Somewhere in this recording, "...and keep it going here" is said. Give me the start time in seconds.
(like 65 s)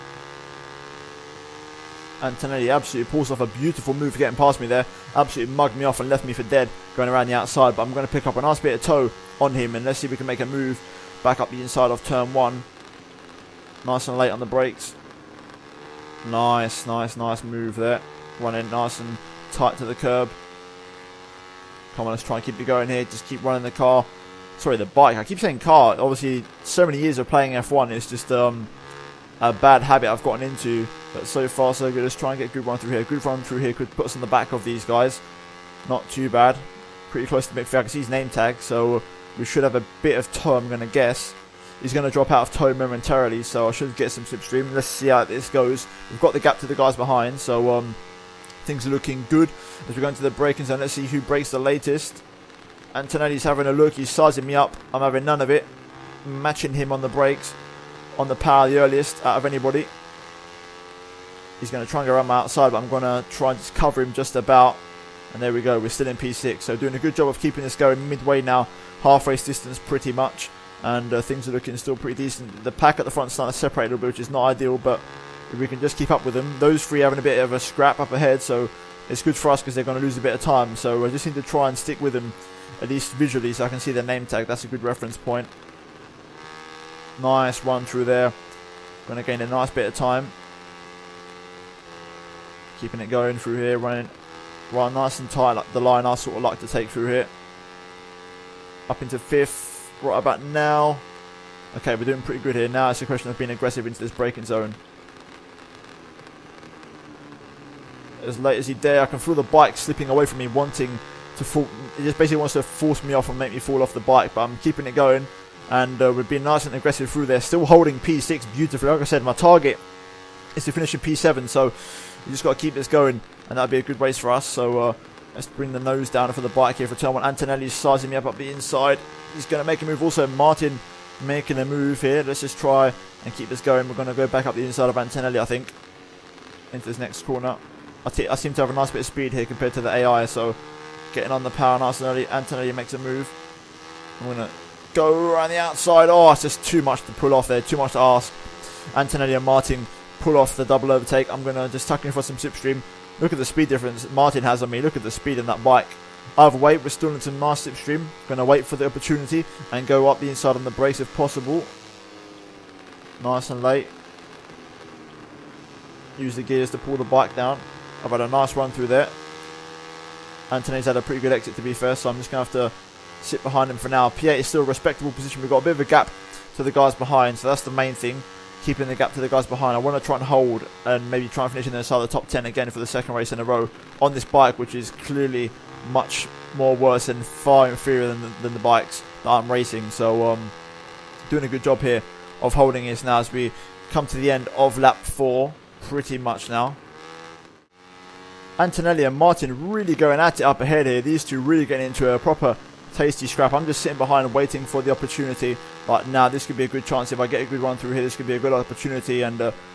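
22 s.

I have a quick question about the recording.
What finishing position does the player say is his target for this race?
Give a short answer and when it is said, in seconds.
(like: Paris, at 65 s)
P7, at 120 s.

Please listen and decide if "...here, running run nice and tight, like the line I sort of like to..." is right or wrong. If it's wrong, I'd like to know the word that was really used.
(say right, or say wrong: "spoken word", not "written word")
right.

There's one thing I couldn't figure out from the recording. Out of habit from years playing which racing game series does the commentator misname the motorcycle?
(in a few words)
F1.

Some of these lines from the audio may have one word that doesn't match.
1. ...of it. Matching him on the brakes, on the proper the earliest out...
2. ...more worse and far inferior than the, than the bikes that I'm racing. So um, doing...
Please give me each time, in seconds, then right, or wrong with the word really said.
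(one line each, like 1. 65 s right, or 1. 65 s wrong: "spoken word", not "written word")
1. 55 s wrong: "power", not "proper"
2. 186 s right.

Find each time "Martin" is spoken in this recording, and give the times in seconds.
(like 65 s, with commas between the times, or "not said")
130 s, 149 s, 154 s, 199 s.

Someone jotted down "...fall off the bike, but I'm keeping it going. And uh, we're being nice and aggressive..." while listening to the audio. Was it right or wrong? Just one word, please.
right.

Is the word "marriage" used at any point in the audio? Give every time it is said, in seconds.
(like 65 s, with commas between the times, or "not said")
not said.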